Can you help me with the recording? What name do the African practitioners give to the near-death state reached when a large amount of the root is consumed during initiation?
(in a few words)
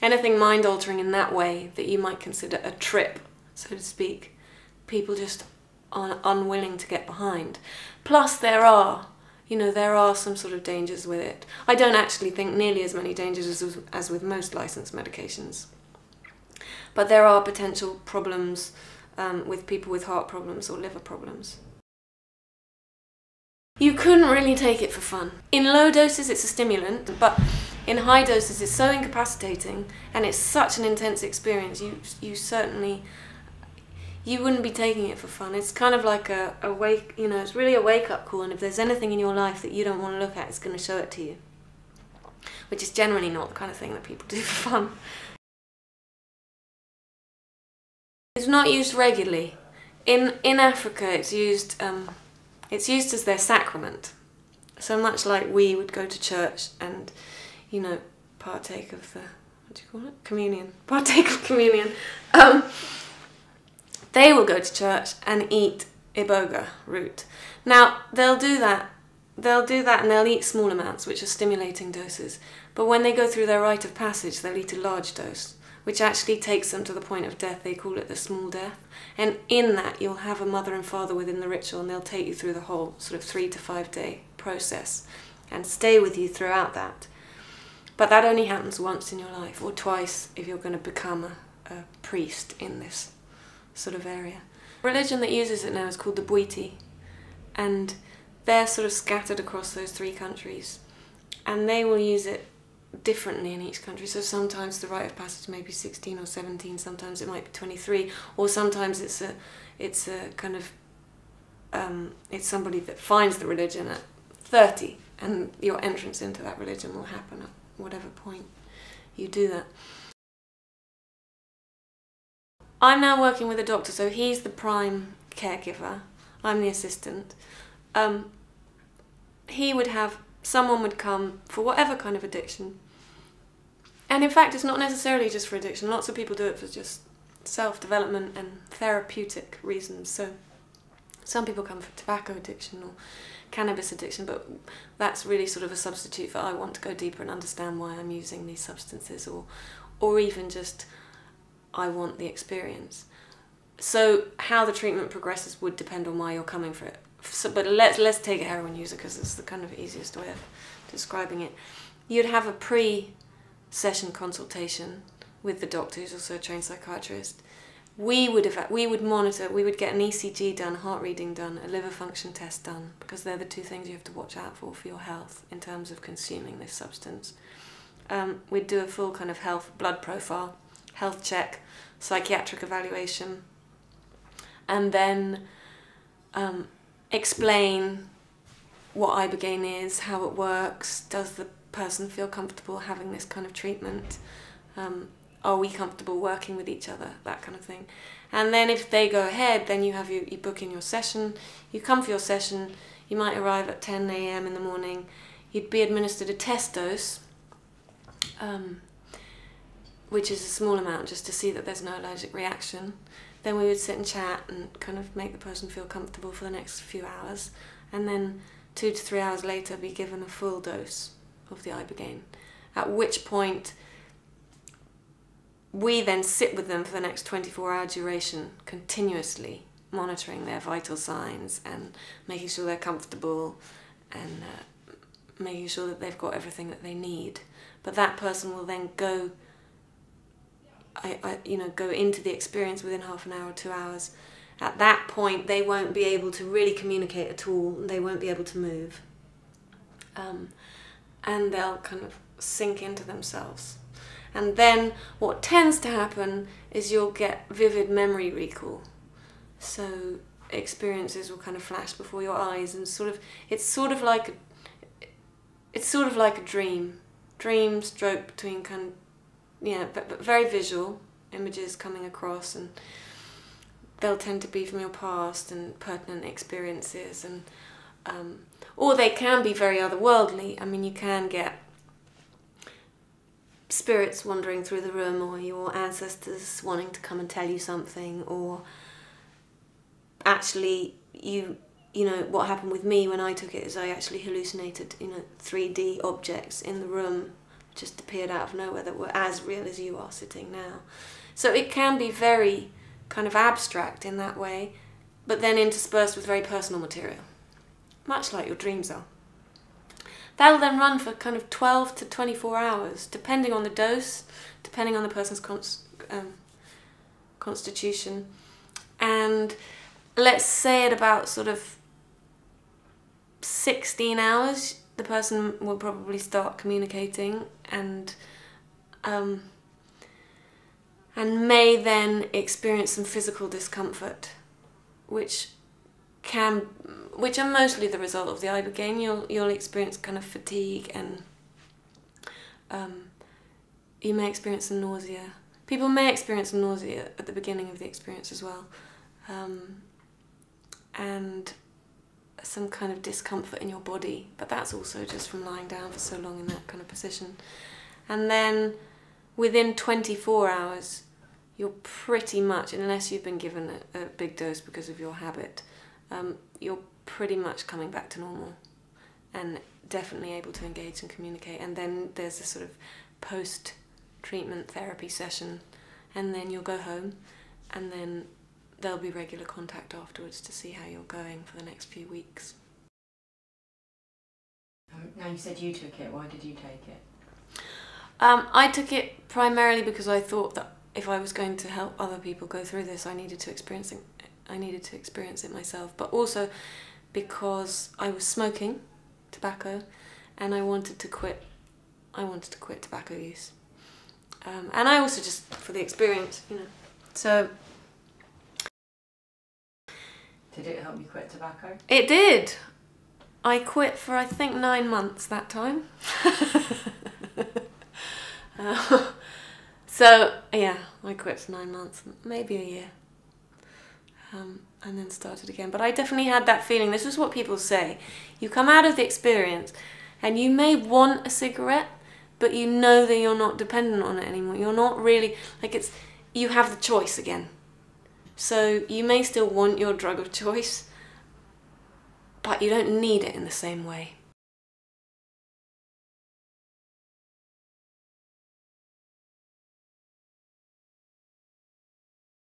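the small death.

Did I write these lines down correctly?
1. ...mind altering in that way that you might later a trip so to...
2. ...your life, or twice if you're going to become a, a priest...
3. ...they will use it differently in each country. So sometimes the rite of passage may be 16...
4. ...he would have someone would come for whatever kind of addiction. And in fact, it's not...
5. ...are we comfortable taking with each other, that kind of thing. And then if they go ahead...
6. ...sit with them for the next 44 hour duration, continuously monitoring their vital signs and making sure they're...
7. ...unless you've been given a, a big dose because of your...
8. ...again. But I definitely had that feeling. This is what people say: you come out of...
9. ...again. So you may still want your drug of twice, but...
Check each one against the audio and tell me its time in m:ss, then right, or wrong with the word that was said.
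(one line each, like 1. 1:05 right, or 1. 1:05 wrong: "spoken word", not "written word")
1. 0:00 wrong: "consider", not "later"
2. 1:29 right
3. 1:41 right
4. 2:09 right
5. 3:15 wrong: "working", not "taking"
6. 3:46 wrong: "24", not "44"
7. 6:02 right
8. 7:05 right
9. 7:17 wrong: "choice", not "twice".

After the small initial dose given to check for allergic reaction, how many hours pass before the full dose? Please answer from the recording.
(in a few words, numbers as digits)
2 to 3 hours.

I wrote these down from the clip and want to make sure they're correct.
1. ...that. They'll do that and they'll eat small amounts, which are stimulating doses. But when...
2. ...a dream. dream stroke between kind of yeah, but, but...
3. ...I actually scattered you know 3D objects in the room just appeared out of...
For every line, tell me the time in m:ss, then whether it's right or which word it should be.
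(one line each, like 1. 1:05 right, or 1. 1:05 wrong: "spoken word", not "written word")
1. 1:08 right
2. 4:26 right
3. 4:53 wrong: "hallucinated", not "scattered".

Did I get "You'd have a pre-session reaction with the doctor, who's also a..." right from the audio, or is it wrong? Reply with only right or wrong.
wrong.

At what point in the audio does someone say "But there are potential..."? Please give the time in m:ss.
0:16.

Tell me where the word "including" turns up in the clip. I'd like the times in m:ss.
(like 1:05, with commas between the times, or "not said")
not said.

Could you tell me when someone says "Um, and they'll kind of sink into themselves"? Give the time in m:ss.
4:10.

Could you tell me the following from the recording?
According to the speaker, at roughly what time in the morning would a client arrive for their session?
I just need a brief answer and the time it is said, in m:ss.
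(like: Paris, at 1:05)
10 a.m., at 3:23.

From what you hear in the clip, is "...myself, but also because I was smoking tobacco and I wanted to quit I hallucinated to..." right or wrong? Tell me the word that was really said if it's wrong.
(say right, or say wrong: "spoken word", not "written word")
wrong: "wanted", not "hallucinated".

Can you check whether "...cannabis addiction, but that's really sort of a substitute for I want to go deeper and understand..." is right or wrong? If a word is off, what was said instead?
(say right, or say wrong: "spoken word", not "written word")
right.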